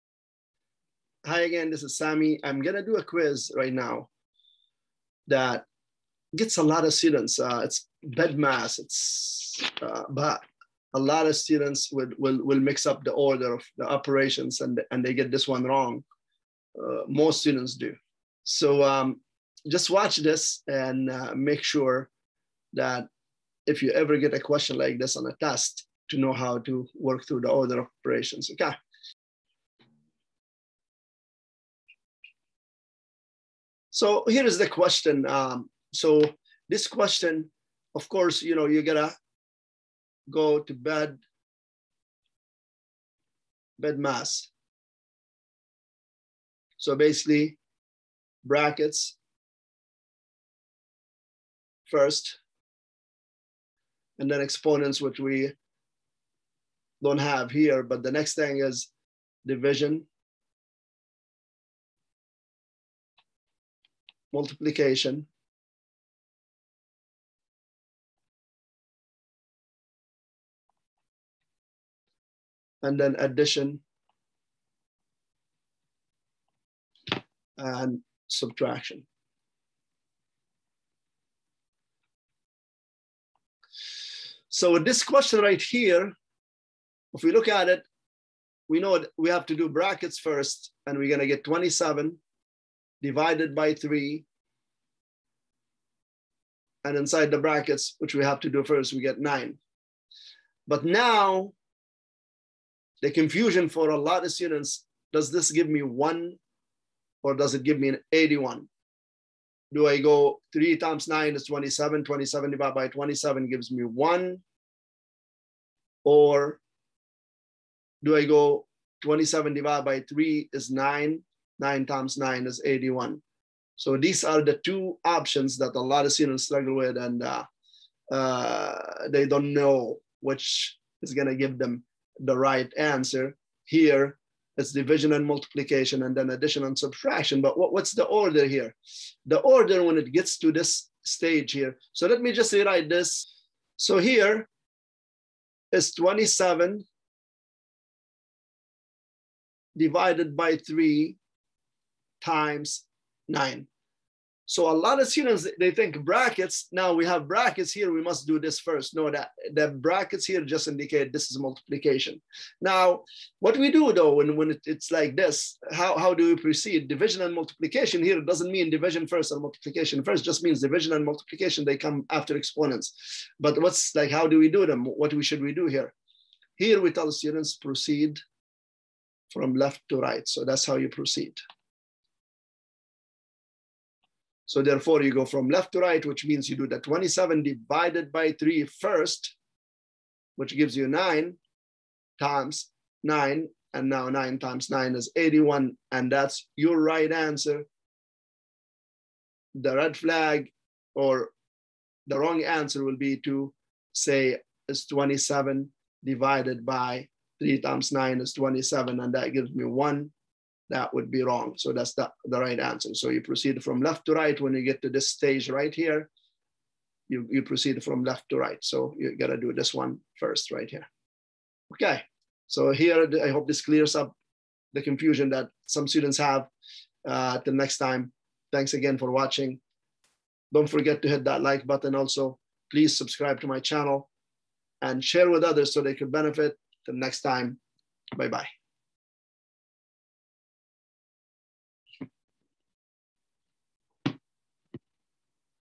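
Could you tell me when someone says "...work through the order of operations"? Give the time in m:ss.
0:26.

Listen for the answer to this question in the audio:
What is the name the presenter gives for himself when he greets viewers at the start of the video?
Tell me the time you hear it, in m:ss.
0:01.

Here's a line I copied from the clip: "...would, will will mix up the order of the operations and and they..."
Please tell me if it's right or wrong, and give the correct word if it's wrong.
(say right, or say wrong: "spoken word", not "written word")
right.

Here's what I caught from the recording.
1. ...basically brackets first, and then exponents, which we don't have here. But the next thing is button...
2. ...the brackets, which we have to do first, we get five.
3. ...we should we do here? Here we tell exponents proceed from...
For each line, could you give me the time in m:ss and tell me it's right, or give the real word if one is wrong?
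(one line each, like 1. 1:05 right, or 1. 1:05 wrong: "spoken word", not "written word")
1. 0:46 wrong: "division", not "button"
2. 1:37 wrong: "nine", not "five"
3. 2:55 wrong: "students", not "exponents".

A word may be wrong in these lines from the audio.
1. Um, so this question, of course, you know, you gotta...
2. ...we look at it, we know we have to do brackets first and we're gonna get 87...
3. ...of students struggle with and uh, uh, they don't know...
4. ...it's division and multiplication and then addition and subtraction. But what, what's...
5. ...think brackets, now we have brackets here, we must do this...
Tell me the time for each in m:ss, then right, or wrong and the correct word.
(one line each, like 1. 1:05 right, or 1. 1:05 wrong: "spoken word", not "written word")
1. 0:35 right
2. 1:27 wrong: "27", not "87"
3. 2:06 right
4. 2:14 right
5. 2:35 right.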